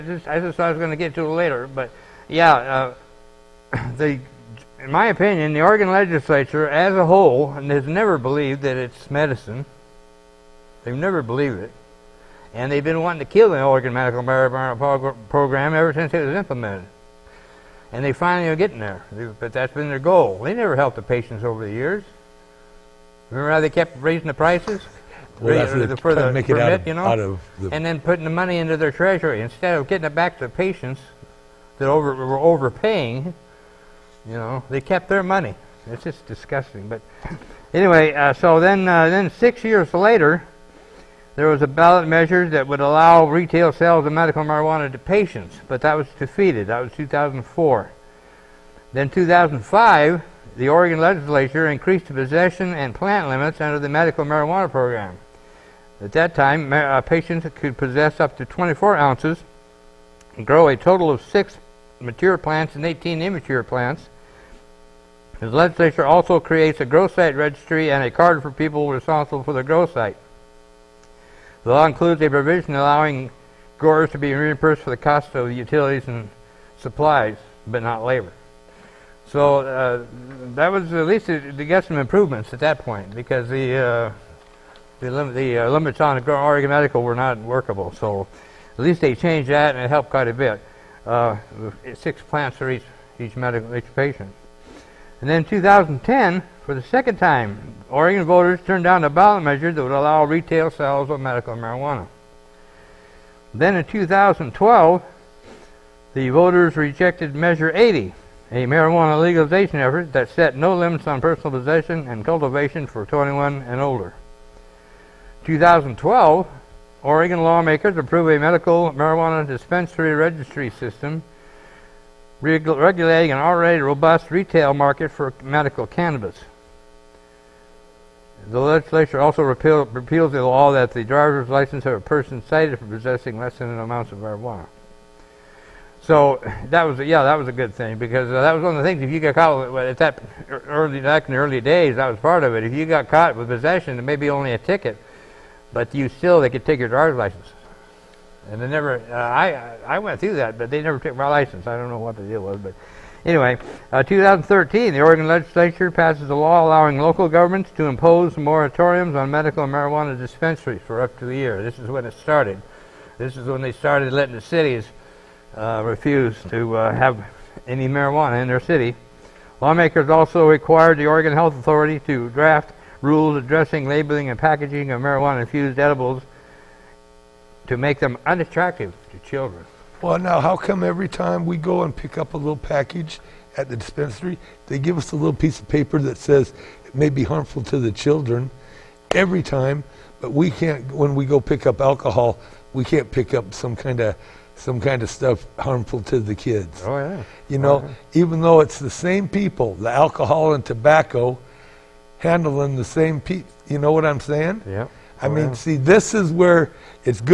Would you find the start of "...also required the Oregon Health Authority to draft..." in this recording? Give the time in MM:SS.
02:50.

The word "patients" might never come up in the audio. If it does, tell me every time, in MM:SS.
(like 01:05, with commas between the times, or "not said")
00:21, 00:30, 00:44, 00:57, 01:33.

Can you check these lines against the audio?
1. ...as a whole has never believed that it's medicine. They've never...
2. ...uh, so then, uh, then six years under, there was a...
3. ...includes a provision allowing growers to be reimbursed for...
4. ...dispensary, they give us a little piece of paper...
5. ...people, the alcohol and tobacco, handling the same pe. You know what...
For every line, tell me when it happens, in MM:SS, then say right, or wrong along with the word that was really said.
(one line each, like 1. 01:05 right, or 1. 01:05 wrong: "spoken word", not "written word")
1. 00:06 right
2. 00:38 wrong: "later", not "under"
3. 01:11 right
4. 03:03 right
5. 03:19 right.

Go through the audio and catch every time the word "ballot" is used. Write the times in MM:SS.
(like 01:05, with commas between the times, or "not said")
00:41, 01:39.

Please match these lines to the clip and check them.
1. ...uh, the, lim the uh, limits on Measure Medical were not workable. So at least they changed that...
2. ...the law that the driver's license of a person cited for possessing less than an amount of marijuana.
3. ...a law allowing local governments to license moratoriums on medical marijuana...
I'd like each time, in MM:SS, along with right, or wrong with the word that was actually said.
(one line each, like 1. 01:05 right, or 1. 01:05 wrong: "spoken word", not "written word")
1. 01:23 wrong: "Oregon", not "Measure"
2. 02:10 right
3. 02:36 wrong: "impose", not "license".